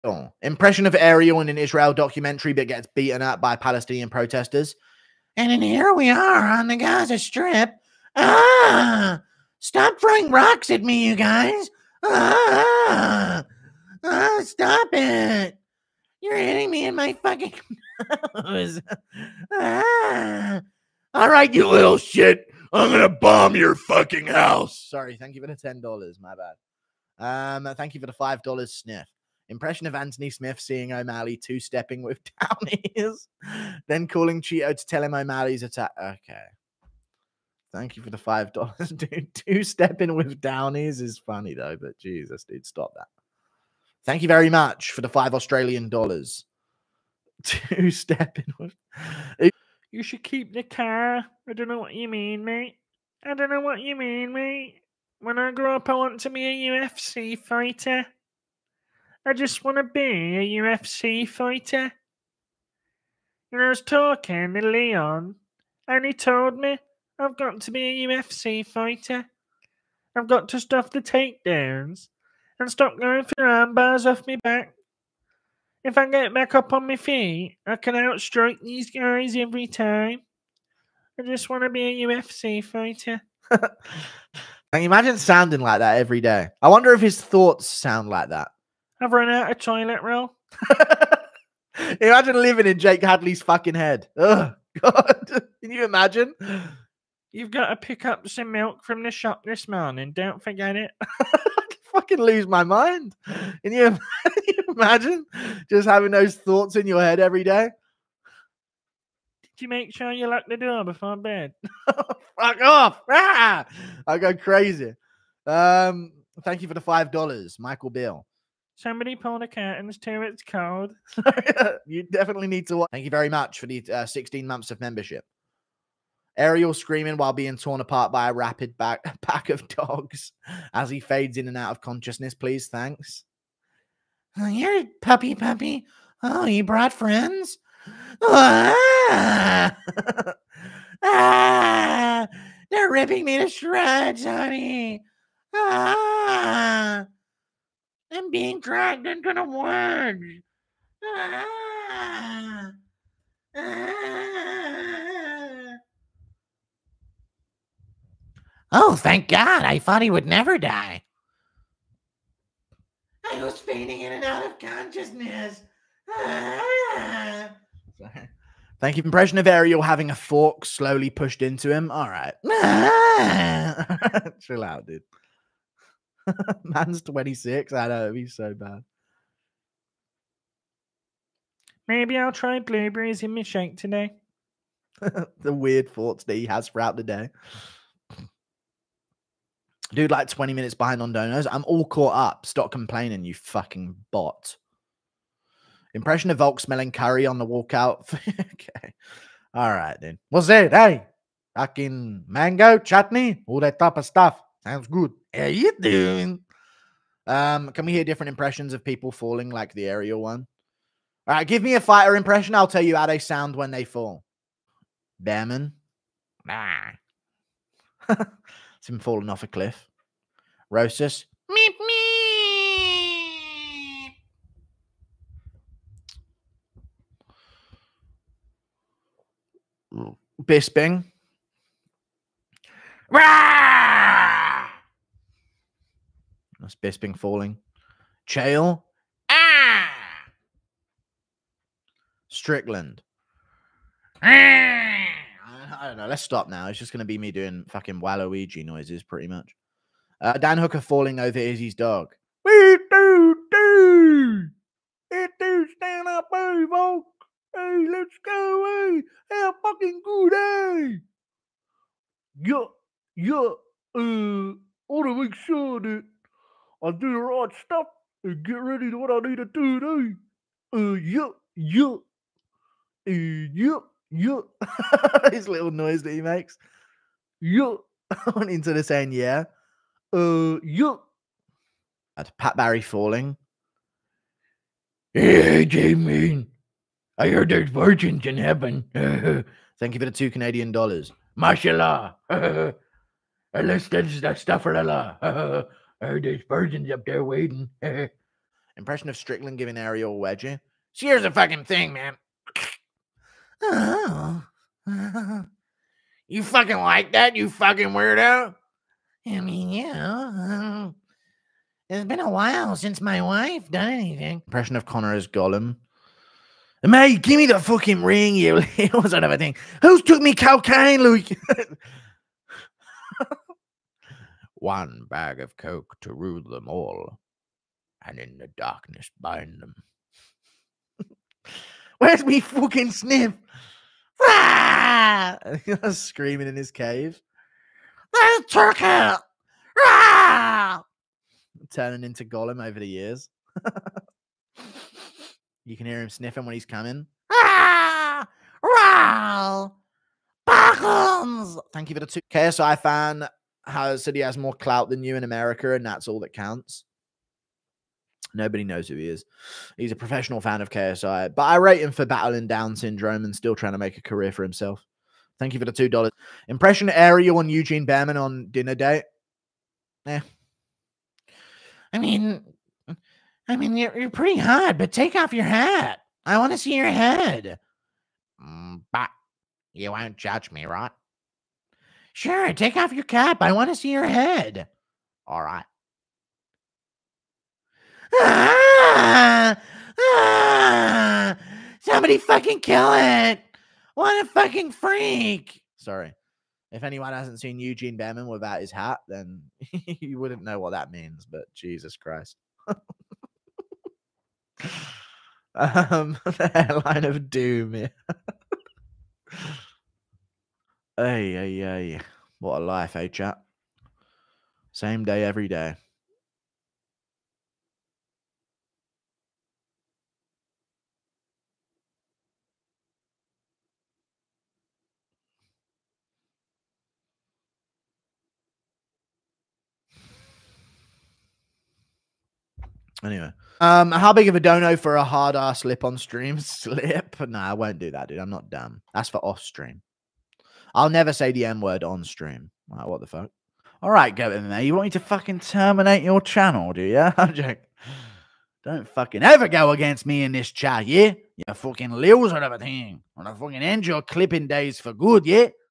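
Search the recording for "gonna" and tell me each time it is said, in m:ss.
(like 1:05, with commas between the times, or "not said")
0:22, 7:33.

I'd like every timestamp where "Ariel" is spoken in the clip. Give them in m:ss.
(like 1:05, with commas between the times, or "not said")
0:00, 2:06, 2:49, 3:29, 4:59.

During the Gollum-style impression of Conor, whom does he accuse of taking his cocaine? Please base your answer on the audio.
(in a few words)
Luke.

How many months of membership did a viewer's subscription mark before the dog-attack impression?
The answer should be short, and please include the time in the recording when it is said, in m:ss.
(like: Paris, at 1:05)
16, at 2:04.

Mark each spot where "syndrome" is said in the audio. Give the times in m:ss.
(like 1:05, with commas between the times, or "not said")
6:02.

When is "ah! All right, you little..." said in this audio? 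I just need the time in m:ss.
0:19.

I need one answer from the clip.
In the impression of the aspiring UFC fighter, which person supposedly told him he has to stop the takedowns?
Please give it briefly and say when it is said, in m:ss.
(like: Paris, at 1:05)
Leon, at 1:04.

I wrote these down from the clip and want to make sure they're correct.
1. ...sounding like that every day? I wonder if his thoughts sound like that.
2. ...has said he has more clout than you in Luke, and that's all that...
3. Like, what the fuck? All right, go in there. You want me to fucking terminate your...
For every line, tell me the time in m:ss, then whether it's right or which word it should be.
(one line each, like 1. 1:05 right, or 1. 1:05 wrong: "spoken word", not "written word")
1. 1:25 right
2. 5:53 wrong: "America", not "Luke"
3. 7:22 right.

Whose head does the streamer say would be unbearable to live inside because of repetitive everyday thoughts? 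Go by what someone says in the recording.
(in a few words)
Jake Hadley.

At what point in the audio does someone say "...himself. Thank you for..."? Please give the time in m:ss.
6:04.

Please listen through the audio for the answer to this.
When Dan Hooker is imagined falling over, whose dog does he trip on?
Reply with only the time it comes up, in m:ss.
4:11.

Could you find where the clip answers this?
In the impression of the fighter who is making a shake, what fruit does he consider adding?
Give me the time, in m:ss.
3:02.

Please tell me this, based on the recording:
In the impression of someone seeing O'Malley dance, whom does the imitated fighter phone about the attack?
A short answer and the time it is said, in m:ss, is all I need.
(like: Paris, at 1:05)
Chito, at 0:34.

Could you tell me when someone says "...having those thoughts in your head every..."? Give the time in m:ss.
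1:45.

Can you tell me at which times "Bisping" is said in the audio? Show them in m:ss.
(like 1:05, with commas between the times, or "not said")
3:50, 3:56.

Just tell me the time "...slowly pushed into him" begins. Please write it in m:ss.
2:50.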